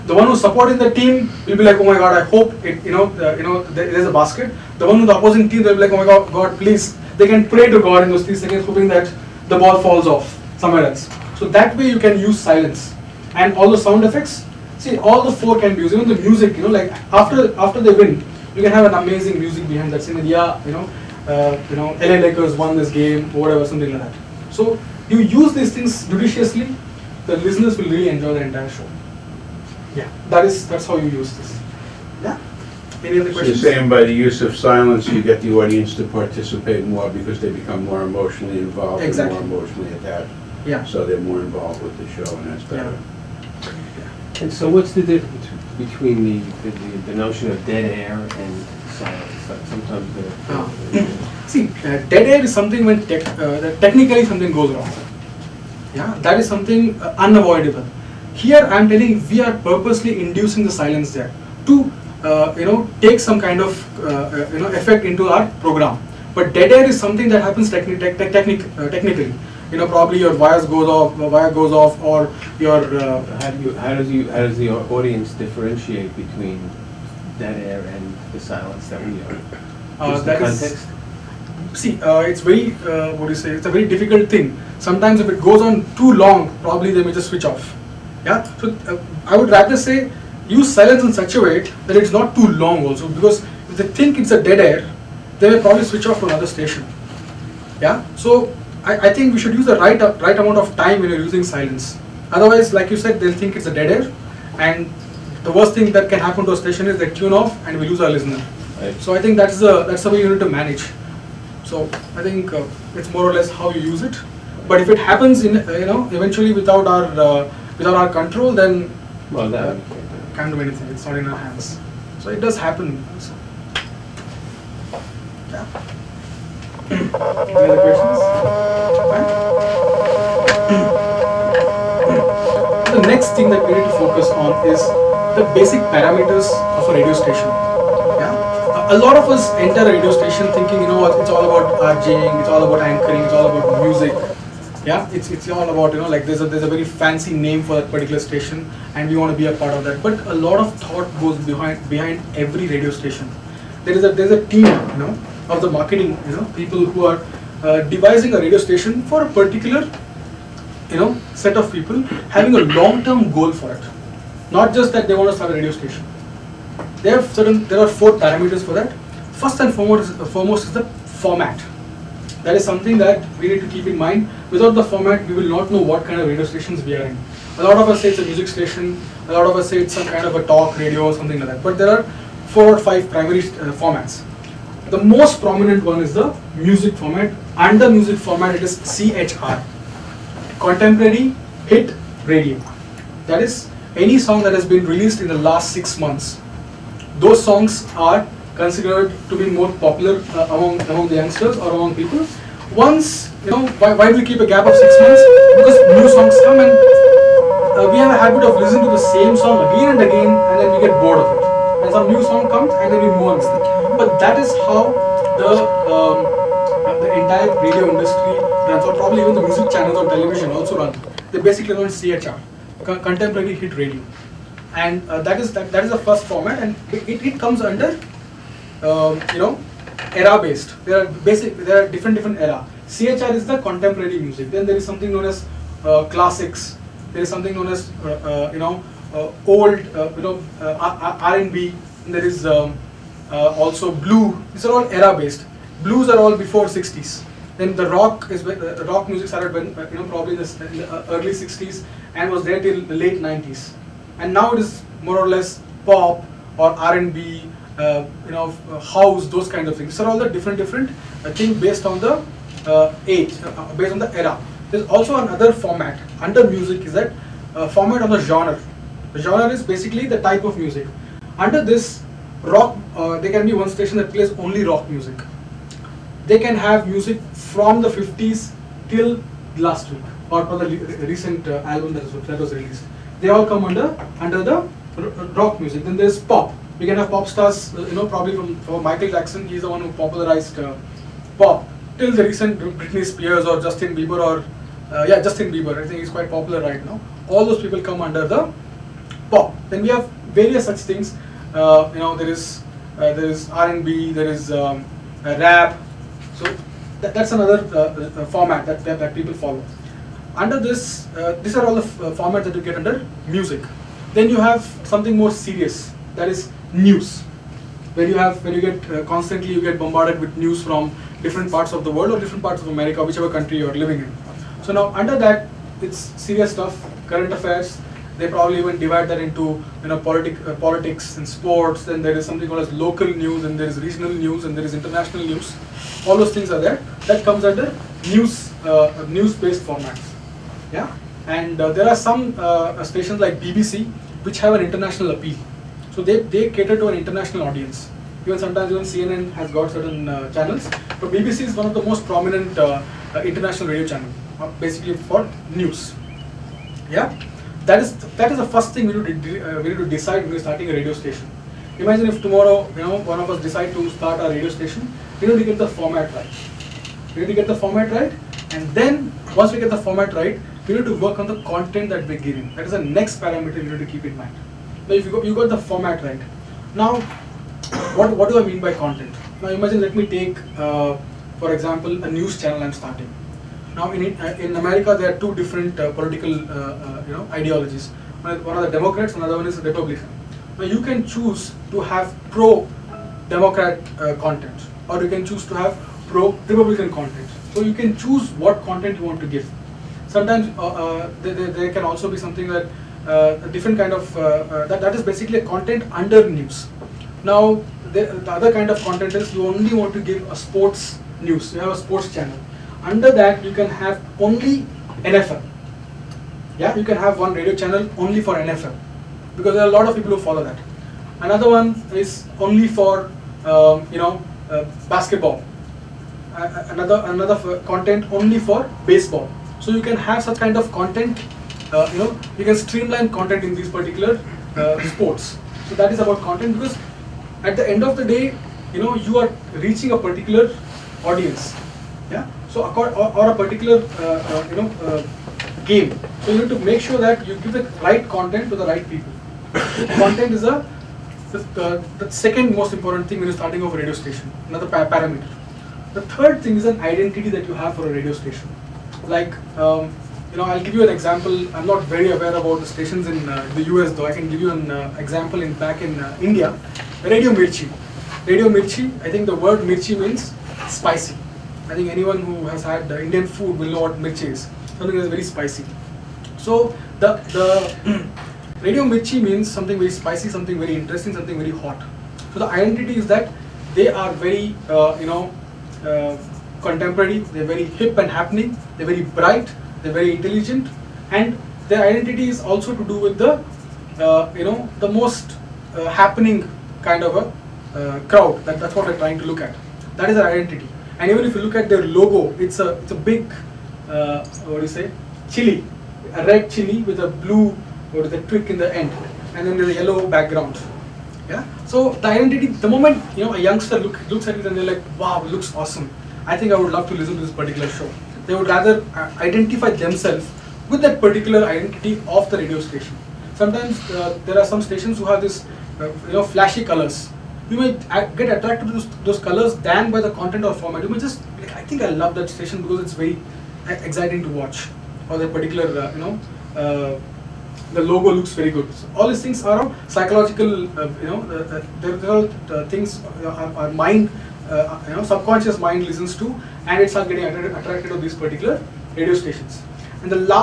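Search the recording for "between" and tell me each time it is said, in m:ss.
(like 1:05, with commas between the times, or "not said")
0:45, 1:16.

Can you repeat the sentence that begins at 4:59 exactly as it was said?
Then we have various such things.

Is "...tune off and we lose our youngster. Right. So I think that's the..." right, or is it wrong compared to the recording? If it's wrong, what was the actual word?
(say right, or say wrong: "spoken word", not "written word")
wrong: "listener", not "youngster".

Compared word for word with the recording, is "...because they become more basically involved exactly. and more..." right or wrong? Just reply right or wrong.
wrong.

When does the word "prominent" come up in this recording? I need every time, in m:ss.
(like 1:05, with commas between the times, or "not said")
3:05, 5:52.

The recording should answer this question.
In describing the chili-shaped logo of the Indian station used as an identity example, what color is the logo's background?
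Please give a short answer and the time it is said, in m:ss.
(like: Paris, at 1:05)
Yellow, at 8:29.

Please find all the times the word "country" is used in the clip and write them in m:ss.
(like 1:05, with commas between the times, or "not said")
5:23.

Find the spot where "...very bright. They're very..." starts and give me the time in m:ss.
8:08.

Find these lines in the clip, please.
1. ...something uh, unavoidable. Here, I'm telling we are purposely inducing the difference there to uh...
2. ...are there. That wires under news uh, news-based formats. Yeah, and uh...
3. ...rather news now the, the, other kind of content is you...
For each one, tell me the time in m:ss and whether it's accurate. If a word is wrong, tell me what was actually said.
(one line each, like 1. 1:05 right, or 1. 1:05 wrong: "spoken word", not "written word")
1. 0:56 wrong: "silence", not "difference"
2. 5:36 wrong: "comes", not "wires"
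3. 6:45 wrong: "under", not "rather".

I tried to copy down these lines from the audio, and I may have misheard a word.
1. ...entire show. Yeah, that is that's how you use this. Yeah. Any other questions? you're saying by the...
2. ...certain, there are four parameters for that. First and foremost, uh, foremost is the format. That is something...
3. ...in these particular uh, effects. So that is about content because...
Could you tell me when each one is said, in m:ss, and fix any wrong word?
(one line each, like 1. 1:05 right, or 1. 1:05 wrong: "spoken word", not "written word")
1. 0:28 right
2. 2:47 right
3. 7:13 wrong: "sports", not "effects".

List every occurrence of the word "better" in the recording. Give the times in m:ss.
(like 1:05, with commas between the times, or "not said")
0:42.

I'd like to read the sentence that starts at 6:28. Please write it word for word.
One are the Democrats, another one is the Republican.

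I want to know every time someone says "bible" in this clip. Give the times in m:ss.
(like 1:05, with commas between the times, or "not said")
not said.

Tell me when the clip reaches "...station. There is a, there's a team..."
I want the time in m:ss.
2:32.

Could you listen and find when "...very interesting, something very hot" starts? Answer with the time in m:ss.
8:00.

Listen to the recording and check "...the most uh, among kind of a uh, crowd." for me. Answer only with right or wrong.
wrong.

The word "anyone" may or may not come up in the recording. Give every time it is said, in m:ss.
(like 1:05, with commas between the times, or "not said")
7:51.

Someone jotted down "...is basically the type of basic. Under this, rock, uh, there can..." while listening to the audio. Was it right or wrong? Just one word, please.
wrong.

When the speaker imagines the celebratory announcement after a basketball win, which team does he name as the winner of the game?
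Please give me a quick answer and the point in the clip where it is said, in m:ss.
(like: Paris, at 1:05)
LA Lakers, at 0:22.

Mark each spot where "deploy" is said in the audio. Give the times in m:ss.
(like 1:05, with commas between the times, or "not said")
not said.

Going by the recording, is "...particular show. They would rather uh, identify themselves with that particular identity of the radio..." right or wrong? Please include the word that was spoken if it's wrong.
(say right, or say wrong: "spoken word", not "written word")
right.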